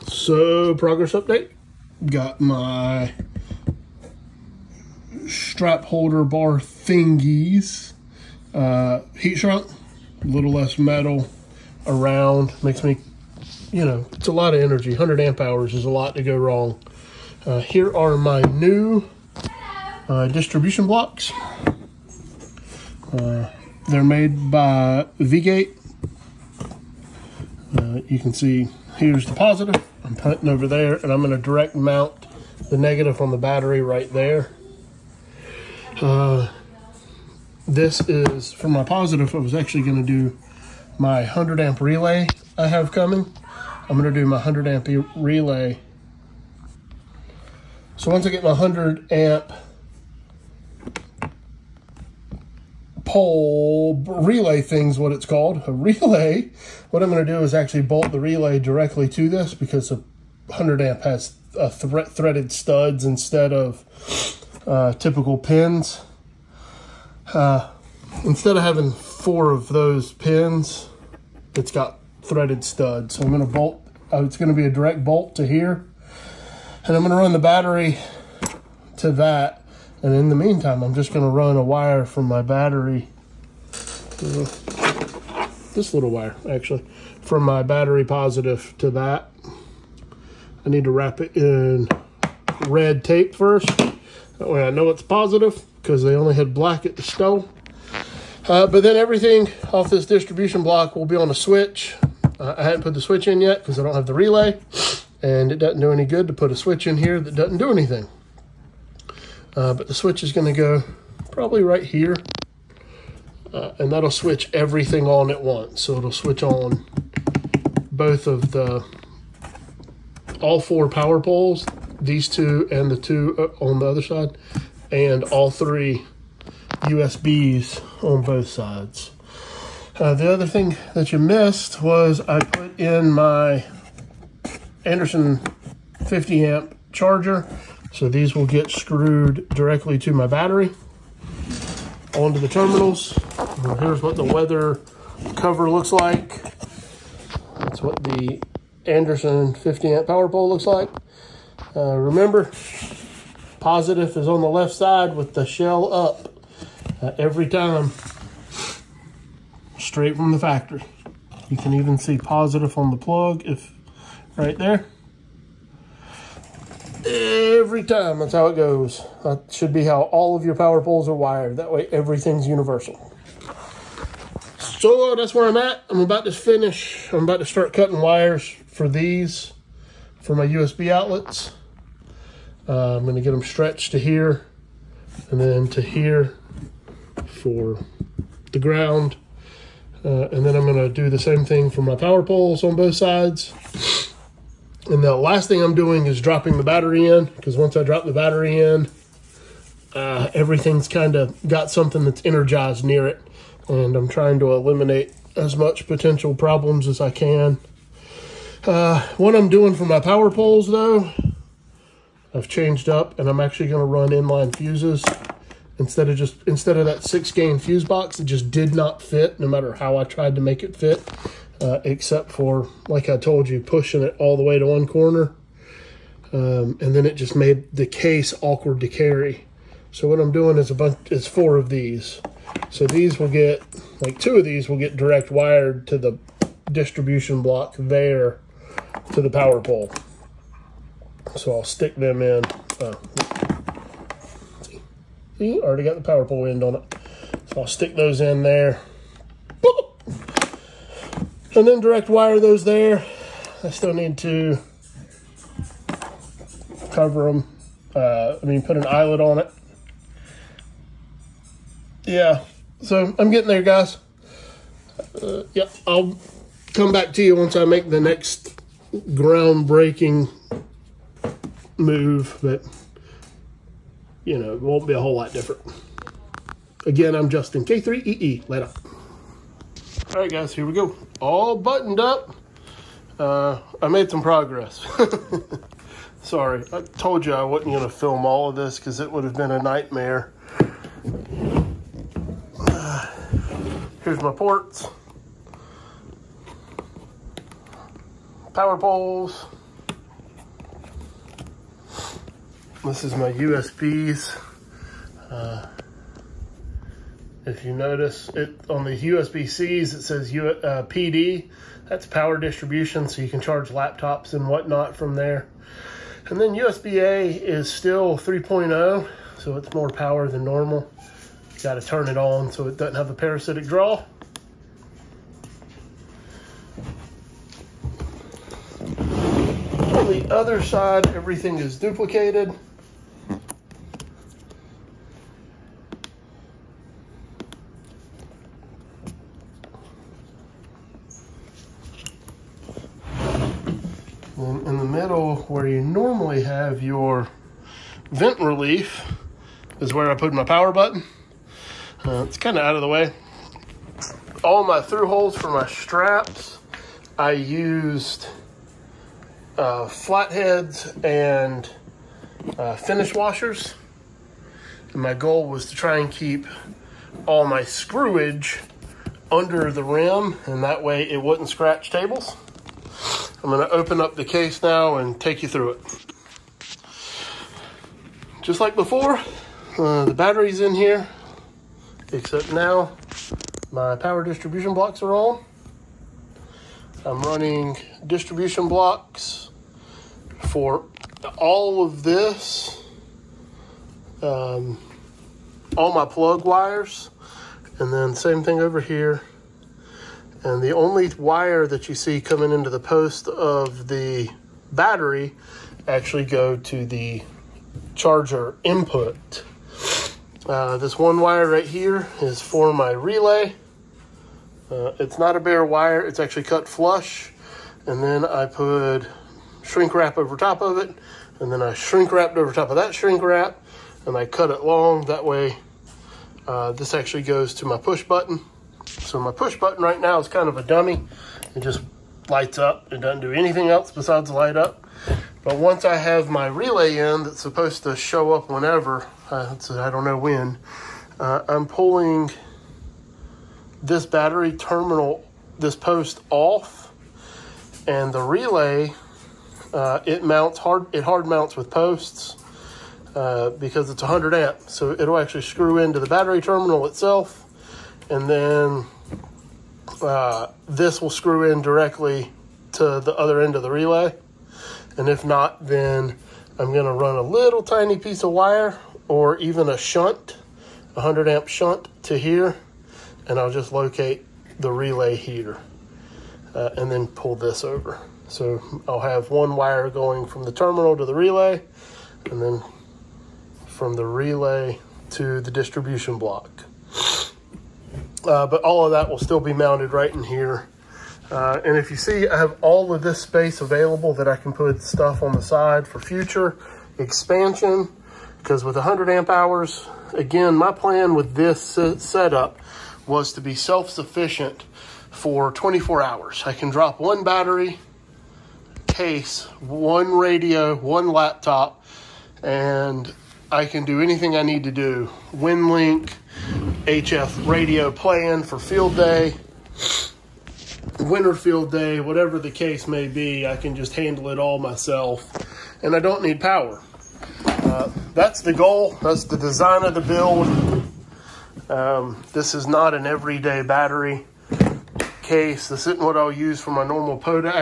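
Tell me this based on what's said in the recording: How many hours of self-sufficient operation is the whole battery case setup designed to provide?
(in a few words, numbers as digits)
24 hours.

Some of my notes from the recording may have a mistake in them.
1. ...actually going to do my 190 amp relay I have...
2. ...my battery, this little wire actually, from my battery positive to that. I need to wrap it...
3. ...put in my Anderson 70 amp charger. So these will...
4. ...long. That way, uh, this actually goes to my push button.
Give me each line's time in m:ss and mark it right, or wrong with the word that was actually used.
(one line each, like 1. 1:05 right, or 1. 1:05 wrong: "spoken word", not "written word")
1. 0:39 wrong: "100", not "190"
2. 1:22 right
3. 2:12 wrong: "50", not "70"
4. 7:04 right.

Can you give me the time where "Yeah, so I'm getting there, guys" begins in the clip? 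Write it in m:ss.
4:22.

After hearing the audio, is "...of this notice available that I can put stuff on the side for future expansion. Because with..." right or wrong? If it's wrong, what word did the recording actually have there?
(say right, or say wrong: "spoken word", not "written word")
wrong: "space", not "notice".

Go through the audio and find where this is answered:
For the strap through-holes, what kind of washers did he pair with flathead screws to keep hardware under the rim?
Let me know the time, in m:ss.
6:02.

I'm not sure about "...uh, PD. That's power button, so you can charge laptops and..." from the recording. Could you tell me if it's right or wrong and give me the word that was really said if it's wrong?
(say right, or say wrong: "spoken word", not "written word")
wrong: "distribution", not "button".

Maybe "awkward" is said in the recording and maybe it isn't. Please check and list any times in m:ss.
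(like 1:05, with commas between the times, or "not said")
3:48.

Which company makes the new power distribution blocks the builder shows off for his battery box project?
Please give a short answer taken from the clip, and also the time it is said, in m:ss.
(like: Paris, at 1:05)
V-Gate, at 0:25.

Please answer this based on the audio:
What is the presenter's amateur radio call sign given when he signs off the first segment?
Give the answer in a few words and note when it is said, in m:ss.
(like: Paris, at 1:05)
K3EE, at 4:37.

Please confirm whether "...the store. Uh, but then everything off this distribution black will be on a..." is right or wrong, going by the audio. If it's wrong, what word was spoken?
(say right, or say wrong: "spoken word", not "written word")
wrong: "block", not "black".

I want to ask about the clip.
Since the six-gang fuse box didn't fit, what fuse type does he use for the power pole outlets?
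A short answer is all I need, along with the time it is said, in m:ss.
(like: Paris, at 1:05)
inline fuses, at 3:34.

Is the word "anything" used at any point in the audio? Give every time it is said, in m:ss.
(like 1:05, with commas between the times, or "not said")
1:47, 7:13, 8:34.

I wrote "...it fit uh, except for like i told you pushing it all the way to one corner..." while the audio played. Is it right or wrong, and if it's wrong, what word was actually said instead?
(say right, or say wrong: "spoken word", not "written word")
right.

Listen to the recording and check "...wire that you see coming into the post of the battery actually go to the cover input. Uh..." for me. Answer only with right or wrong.
wrong.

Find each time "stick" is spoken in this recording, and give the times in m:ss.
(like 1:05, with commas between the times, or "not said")
4:01, 4:07.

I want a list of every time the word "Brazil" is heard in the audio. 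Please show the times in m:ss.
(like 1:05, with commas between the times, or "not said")
not said.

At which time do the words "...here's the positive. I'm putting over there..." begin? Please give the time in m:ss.
0:28.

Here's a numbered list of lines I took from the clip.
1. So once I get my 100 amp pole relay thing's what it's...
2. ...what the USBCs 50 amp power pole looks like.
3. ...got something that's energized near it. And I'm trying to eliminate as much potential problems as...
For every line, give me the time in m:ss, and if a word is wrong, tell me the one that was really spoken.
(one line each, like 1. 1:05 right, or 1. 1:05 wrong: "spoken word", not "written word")
1. 0:47 right
2. 2:27 wrong: "Anderson", not "USBCs"
3. 3:21 right.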